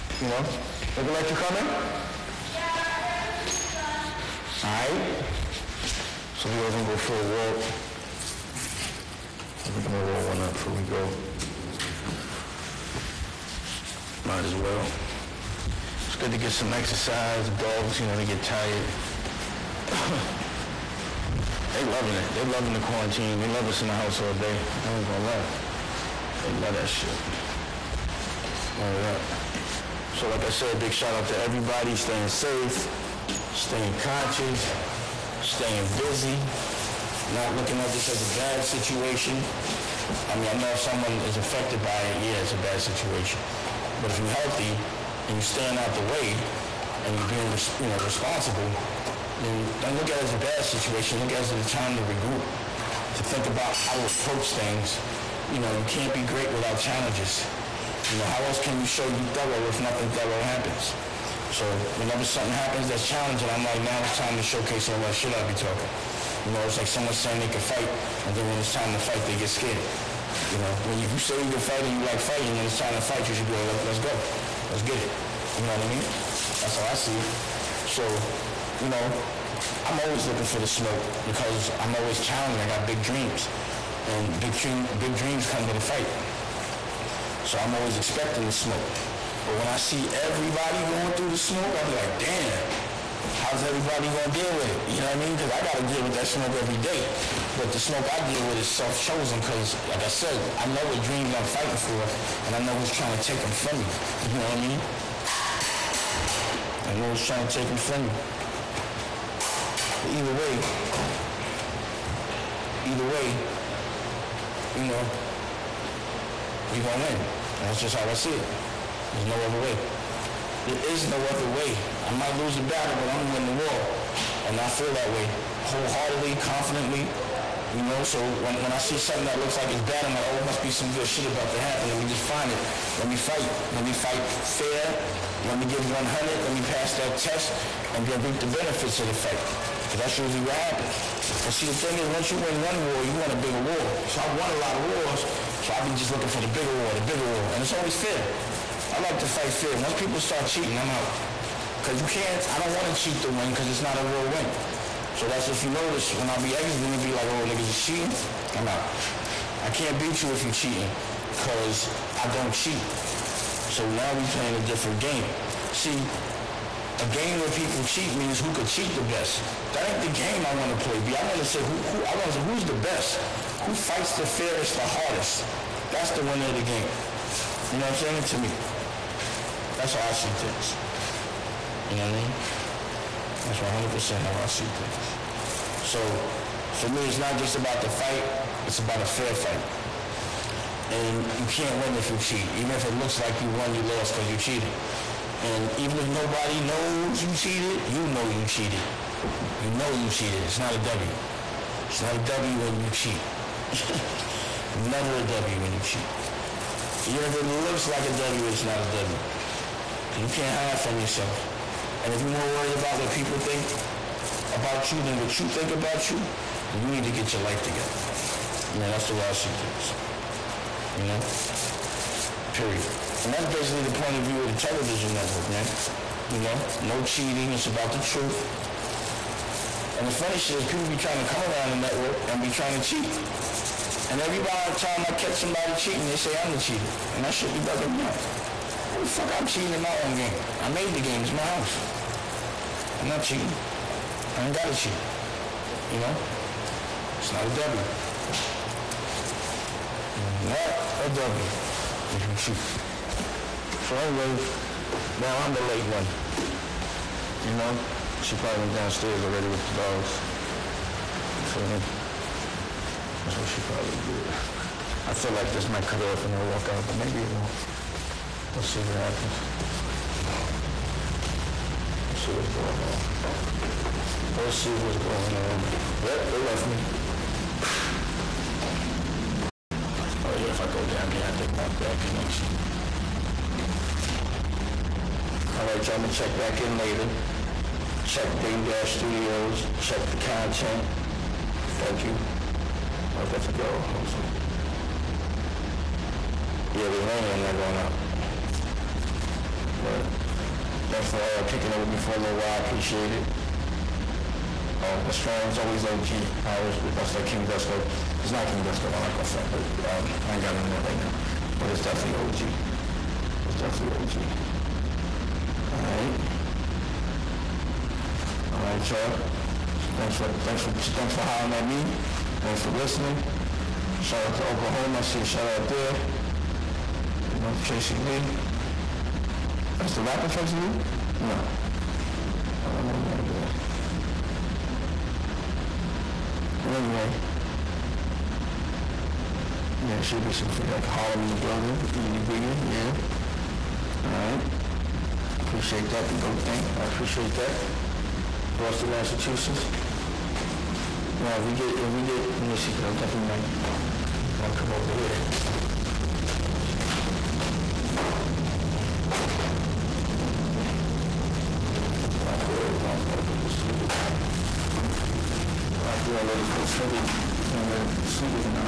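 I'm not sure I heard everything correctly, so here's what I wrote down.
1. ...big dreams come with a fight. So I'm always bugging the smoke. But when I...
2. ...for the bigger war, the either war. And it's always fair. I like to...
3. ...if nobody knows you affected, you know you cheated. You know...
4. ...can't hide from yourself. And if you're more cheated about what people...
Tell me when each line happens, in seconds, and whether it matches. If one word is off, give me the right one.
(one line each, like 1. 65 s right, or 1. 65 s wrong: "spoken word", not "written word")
1. 84 s wrong: "expecting", not "bugging"
2. 146 s wrong: "bigger", not "either"
3. 195 s wrong: "cheated", not "affected"
4. 210 s wrong: "worried", not "cheated".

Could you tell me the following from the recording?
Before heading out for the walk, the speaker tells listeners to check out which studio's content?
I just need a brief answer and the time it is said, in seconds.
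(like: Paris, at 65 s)
Dame Dash Studios, at 288 s.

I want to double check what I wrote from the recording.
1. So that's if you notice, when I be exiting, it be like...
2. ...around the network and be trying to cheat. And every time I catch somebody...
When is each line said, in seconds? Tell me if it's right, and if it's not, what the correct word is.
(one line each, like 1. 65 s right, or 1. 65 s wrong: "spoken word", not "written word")
1. 155 s right
2. 231 s right.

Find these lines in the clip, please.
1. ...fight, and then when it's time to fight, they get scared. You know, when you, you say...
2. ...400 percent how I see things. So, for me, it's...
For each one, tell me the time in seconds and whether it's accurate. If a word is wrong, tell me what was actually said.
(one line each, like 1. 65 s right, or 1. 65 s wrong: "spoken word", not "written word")
1. 67 s right
2. 183 s wrong: "100", not "400".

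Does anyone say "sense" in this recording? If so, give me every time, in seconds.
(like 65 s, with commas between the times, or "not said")
not said.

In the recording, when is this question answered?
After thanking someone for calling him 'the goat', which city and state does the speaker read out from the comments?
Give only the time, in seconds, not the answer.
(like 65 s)
348 s.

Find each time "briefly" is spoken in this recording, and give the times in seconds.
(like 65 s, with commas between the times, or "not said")
not said.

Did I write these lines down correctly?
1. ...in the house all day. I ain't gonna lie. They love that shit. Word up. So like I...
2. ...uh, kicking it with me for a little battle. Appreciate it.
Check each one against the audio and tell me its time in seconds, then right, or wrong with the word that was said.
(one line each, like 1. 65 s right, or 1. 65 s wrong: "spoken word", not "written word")
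1. 23 s right
2. 301 s wrong: "while", not "battle".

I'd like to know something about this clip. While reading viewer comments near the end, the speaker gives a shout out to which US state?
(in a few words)
Oklahoma.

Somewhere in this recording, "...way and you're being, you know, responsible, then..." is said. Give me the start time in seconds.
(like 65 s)
46 s.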